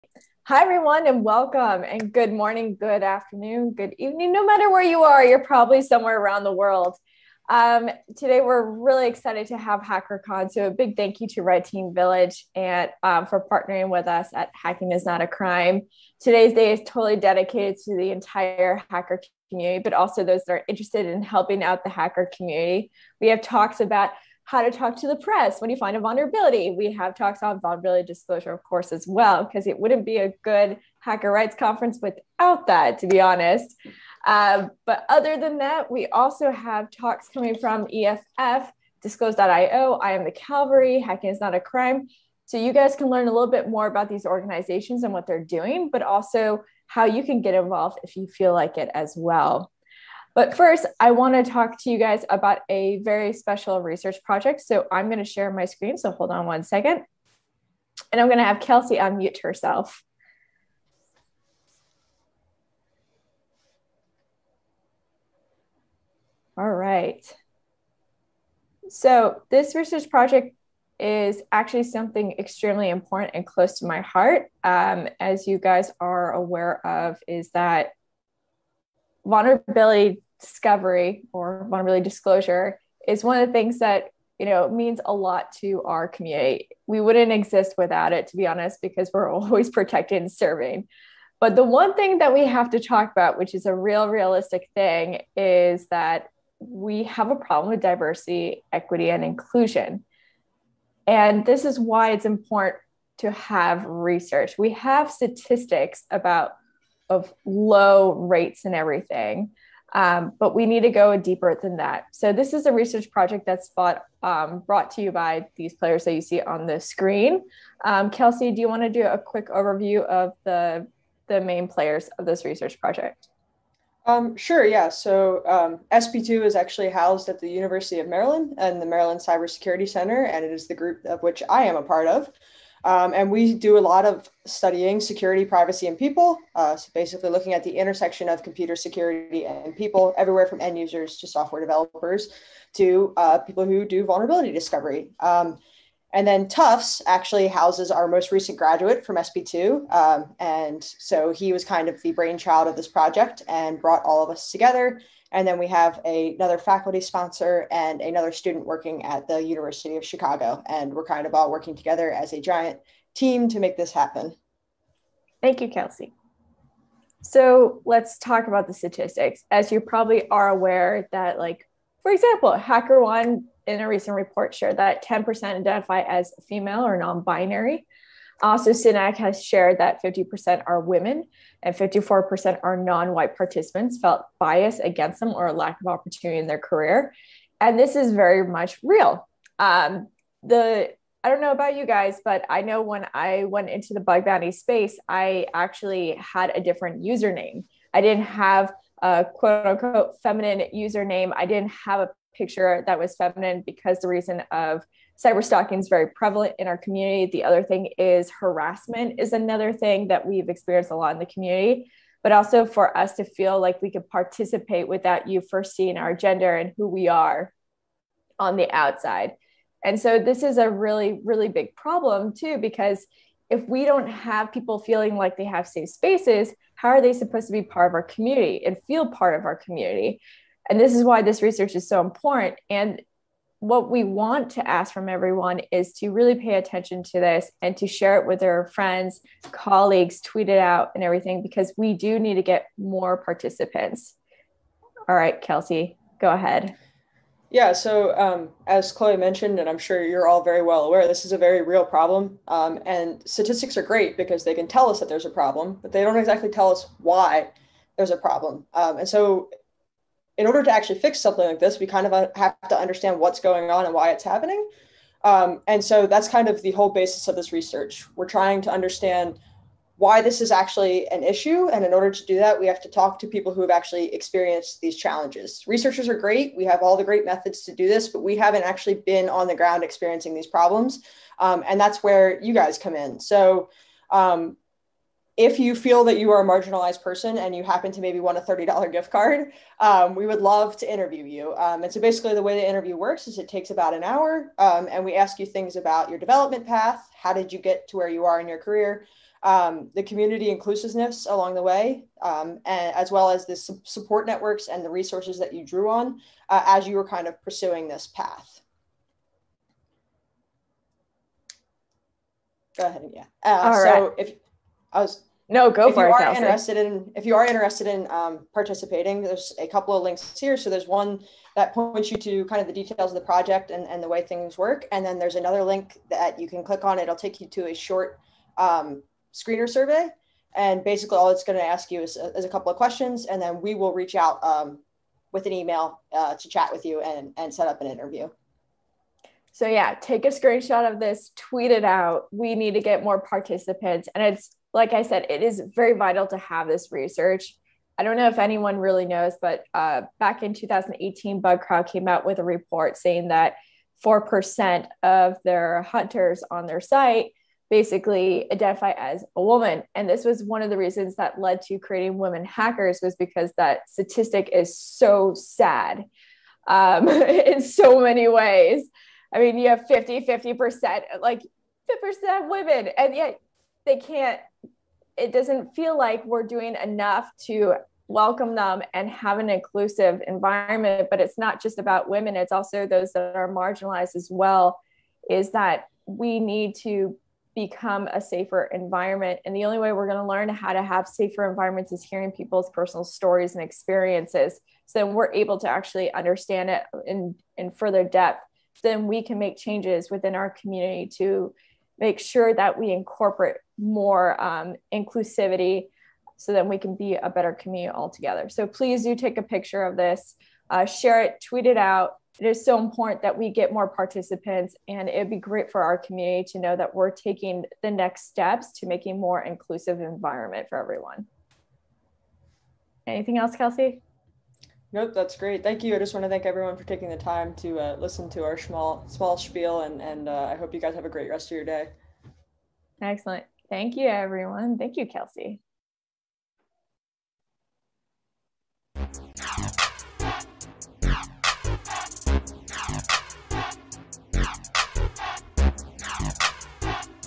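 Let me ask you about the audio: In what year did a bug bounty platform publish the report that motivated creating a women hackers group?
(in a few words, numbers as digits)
2018.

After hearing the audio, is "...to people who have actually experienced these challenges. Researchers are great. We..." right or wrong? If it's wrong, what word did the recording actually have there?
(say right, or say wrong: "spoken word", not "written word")
right.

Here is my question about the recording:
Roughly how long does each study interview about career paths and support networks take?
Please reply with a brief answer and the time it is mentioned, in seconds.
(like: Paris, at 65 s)
about an hour, at 293 s.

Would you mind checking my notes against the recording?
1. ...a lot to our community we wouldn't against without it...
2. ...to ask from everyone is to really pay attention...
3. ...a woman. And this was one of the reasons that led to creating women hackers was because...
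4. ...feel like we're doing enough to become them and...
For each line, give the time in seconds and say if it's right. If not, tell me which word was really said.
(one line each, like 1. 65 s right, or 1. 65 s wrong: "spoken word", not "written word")
1. 85 s wrong: "exist", not "against"
2. 234 s right
3. 359 s right
4. 375 s wrong: "welcome", not "become".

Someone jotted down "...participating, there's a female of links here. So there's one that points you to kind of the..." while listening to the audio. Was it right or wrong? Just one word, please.
wrong.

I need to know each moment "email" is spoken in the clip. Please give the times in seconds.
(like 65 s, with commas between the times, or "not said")
335 s.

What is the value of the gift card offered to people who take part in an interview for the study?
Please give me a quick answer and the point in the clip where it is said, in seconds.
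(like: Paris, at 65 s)
$30, at 288 s.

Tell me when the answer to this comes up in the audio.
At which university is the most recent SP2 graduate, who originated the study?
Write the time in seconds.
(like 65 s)
146 s.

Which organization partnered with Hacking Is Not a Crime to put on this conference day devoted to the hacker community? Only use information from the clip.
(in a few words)
Red Team Village.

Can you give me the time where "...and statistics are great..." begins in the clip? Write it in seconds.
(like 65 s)
252 s.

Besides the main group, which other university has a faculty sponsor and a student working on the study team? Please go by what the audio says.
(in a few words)
University of Chicago.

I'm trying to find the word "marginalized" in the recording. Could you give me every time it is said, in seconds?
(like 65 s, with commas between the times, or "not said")
286 s, 383 s.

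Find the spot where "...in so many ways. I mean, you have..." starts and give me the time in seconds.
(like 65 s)
367 s.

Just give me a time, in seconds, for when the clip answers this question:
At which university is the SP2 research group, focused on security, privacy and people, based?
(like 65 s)
127 s.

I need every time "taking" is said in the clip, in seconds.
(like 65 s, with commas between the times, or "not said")
417 s, 426 s.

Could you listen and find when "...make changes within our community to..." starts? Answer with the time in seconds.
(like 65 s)
399 s.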